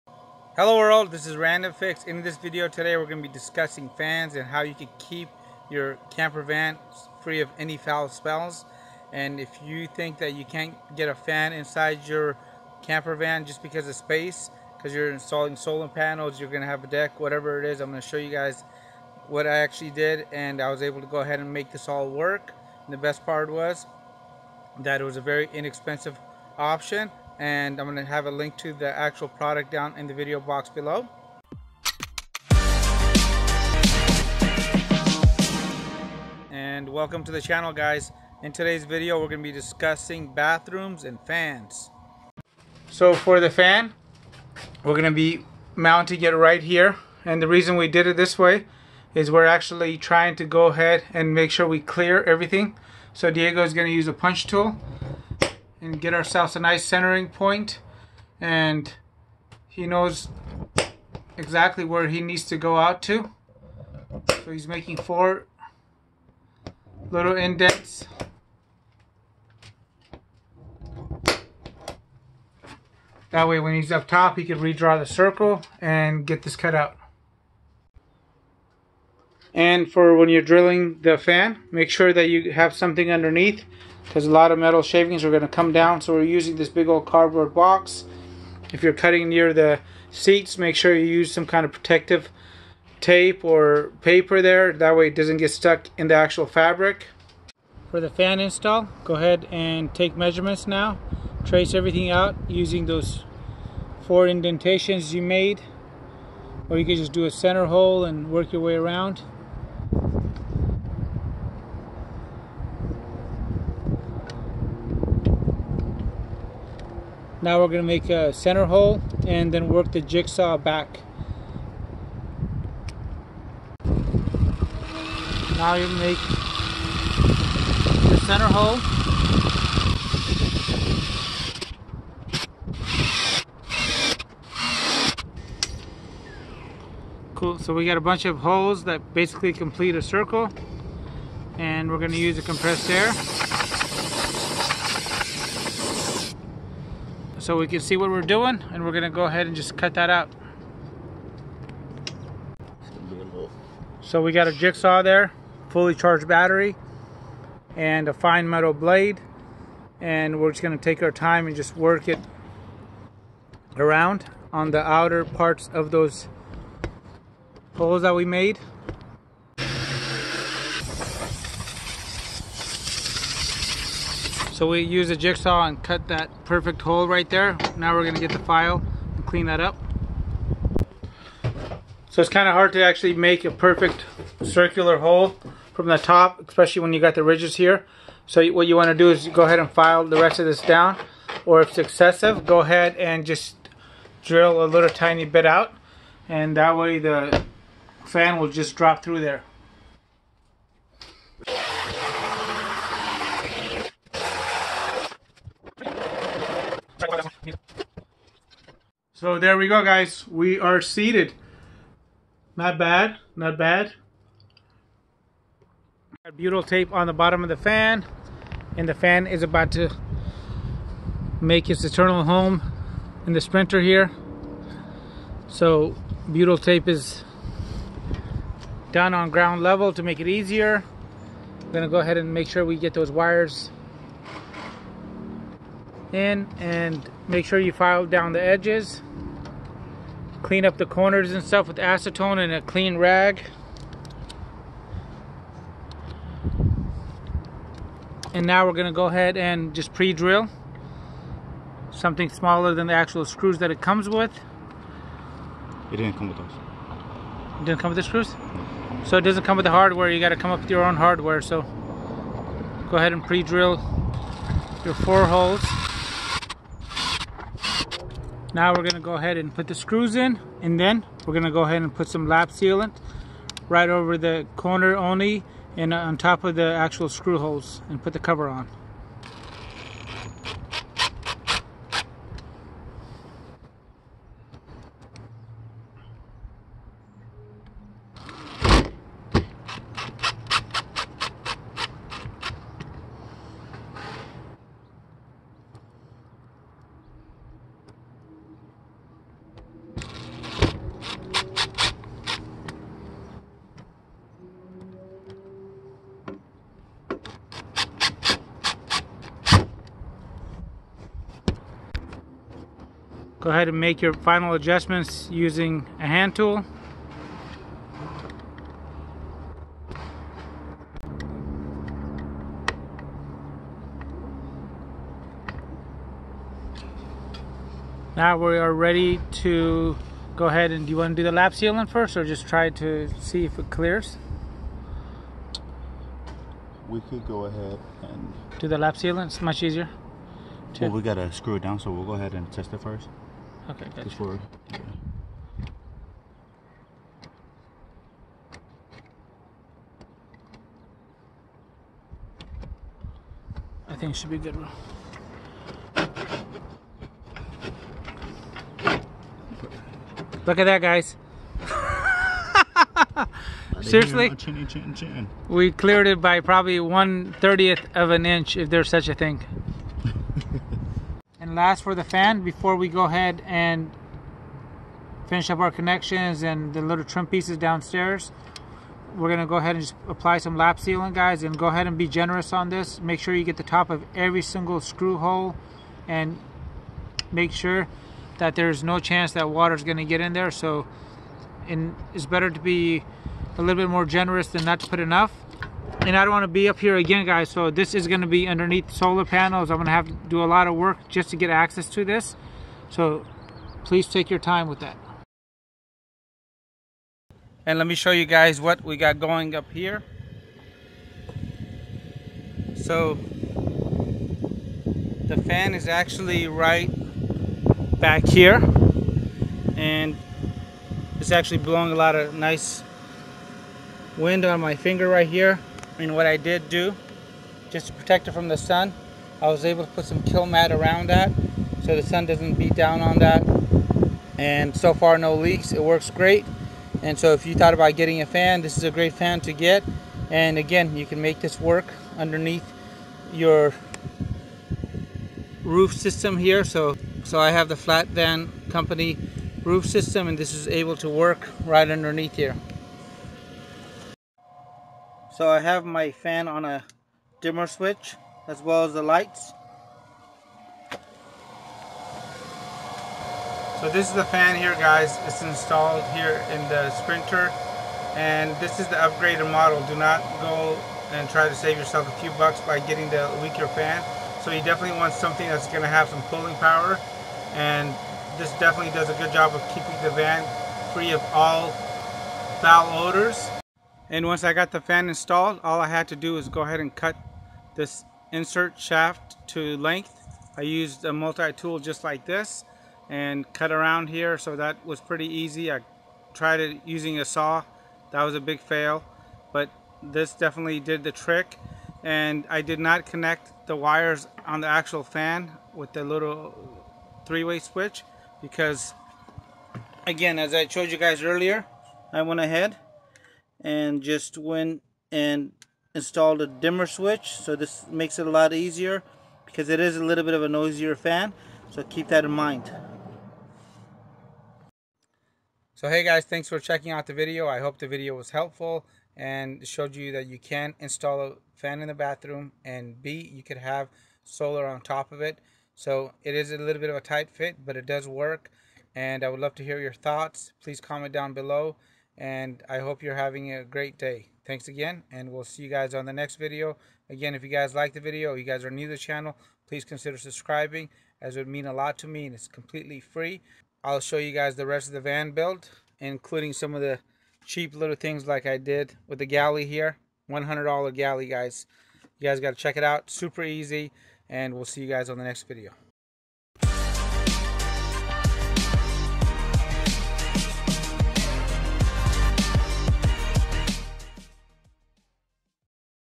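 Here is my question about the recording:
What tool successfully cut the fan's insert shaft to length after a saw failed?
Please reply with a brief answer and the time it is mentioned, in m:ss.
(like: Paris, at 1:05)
multi-tool, at 8:11.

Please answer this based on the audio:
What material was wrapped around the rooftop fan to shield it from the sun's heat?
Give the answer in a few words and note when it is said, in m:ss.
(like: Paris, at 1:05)
Kilmat, at 7:10.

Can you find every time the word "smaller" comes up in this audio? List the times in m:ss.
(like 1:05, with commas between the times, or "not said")
4:12.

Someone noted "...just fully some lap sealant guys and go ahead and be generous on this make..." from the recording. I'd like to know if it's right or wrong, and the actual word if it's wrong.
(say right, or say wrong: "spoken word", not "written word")
wrong: "apply", not "fully".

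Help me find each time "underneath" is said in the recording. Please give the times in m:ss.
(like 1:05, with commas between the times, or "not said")
1:23, 6:38, 7:22, 7:31.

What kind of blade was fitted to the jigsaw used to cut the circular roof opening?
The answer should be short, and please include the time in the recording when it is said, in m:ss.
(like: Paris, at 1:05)
fine metal blade, at 2:38.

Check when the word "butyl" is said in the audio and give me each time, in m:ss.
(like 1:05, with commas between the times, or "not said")
3:36, 3:46.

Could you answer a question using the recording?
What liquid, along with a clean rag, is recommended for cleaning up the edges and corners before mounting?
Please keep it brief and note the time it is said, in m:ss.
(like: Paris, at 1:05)
acetone, at 4:01.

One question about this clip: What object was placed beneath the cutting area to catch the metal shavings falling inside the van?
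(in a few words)
cardboard box.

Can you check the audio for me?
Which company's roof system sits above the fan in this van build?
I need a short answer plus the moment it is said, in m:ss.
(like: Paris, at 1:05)
Flat Van Company, at 7:27.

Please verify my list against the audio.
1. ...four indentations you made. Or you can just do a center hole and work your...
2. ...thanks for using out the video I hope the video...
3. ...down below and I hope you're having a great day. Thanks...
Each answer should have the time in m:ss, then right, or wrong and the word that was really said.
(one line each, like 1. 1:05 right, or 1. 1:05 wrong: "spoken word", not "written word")
1. 1:44 right
2. 8:46 wrong: "checking", not "using"
3. 9:01 right.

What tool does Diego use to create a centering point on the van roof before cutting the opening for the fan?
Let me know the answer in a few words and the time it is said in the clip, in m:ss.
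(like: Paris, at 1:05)
punch tool, at 0:54.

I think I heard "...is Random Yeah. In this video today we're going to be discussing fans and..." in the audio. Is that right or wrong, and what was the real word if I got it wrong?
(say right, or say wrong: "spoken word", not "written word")
wrong: "Fix", not "Yeah".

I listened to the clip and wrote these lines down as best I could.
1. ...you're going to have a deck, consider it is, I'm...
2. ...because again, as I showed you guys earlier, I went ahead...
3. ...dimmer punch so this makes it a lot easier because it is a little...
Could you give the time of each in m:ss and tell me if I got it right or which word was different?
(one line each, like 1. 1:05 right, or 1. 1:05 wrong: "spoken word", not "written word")
1. 0:16 wrong: "whatever", not "consider"
2. 8:28 right
3. 8:36 wrong: "switch", not "punch".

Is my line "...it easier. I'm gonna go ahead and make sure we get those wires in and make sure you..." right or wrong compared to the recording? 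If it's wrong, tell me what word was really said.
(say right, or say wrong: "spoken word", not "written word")
right.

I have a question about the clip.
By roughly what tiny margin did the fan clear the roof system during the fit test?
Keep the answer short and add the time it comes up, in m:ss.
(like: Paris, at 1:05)
1/30th of an inch, at 6:06.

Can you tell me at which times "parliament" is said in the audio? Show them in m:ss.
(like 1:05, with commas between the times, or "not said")
not said.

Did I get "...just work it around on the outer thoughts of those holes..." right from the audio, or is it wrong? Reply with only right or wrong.
wrong.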